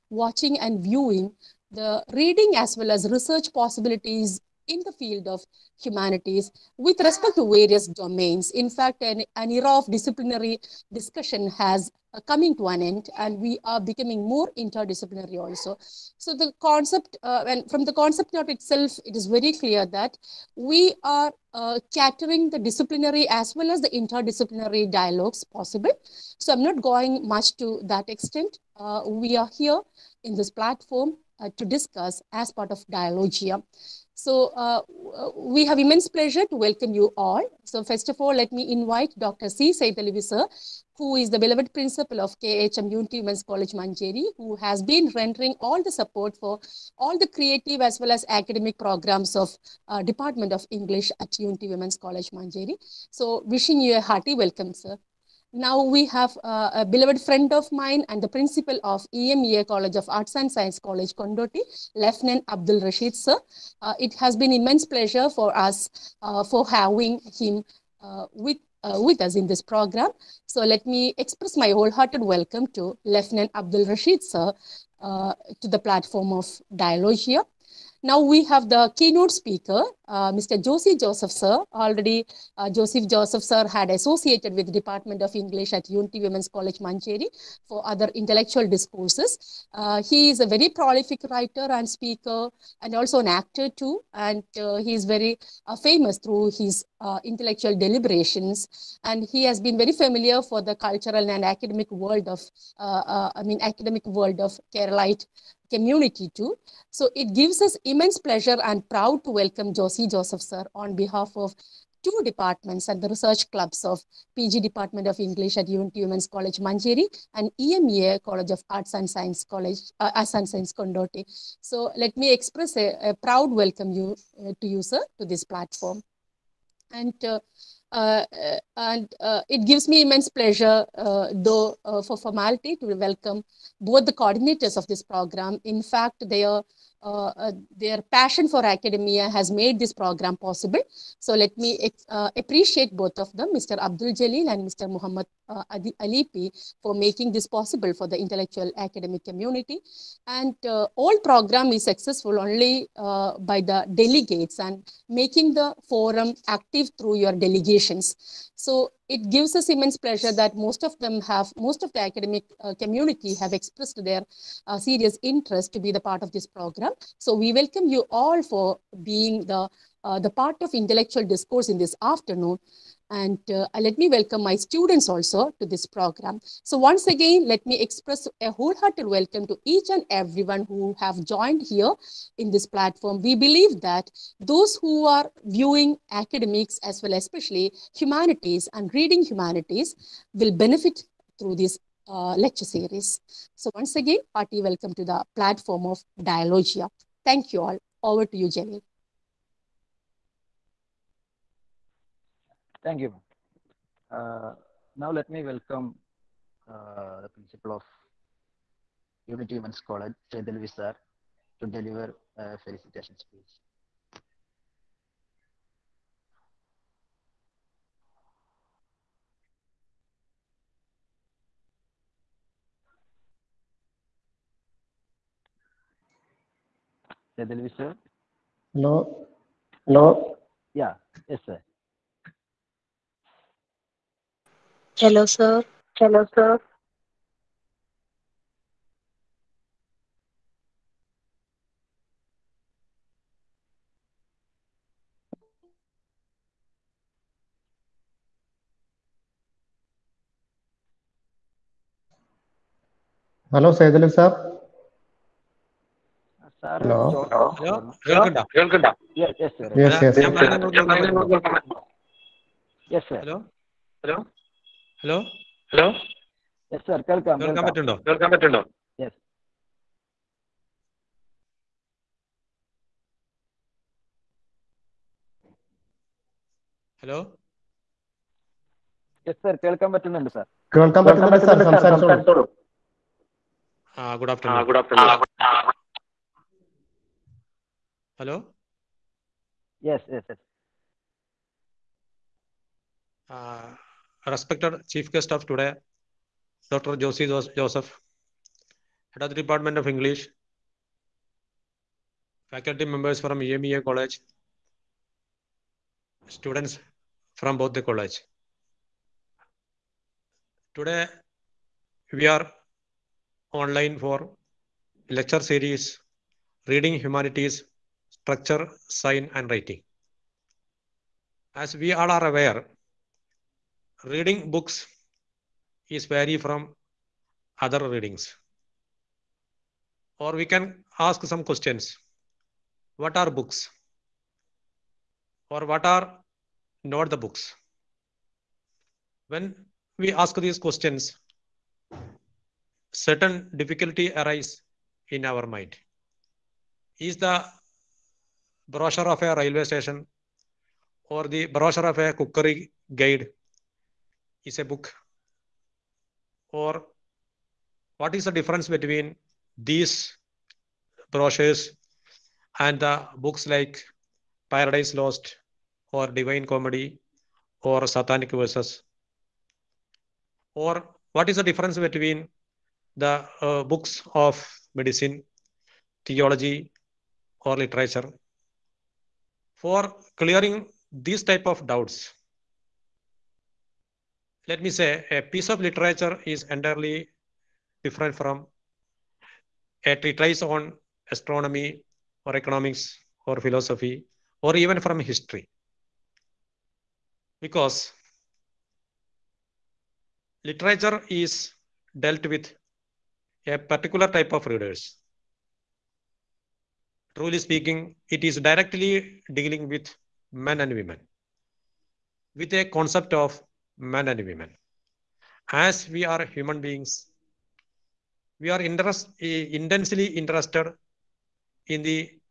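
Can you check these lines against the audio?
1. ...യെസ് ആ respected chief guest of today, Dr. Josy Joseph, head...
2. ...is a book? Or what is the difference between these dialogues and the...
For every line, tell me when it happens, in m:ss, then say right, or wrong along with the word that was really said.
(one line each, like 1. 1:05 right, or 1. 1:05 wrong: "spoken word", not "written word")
1. 4:50 right
2. 5:54 wrong: "brochures", not "dialogues".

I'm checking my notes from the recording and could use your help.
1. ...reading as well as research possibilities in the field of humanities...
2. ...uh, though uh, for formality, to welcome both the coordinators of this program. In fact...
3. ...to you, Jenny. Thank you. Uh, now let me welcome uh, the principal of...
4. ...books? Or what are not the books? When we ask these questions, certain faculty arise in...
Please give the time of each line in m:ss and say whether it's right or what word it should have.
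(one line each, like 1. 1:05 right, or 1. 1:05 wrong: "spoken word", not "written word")
1. 0:02 right
2. 2:10 right
3. 3:18 right
4. 5:33 wrong: "difficulty", not "faculty".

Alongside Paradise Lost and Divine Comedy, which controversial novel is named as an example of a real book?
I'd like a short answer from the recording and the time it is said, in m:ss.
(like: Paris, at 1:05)
Satanic Verses, at 6:07.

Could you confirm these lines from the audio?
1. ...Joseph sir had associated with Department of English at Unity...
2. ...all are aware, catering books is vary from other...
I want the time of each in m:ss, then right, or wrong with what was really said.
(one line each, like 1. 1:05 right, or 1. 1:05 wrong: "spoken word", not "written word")
1. 1:23 right
2. 5:21 wrong: "reading", not "catering".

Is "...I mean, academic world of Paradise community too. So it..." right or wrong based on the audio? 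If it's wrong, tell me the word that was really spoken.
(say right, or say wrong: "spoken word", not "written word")
wrong: "Keralite", not "Paradise".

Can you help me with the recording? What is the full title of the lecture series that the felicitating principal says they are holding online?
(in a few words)
Reading Humanities, Structure, Sign and Writing.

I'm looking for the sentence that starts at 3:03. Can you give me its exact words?
We believe that those who are viewing academics as well, especially humanities and reading humanities will benefit through this uh, lecture series.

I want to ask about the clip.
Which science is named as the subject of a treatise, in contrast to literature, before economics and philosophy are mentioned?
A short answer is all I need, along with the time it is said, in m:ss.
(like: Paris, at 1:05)
Astronomy, at 6:31.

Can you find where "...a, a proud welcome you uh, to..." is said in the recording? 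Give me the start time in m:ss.
2:02.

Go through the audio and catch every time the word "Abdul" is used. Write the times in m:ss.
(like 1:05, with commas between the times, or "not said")
1:02, 1:13, 2:23.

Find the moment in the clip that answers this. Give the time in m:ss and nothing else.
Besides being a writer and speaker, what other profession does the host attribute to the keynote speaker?
1:33.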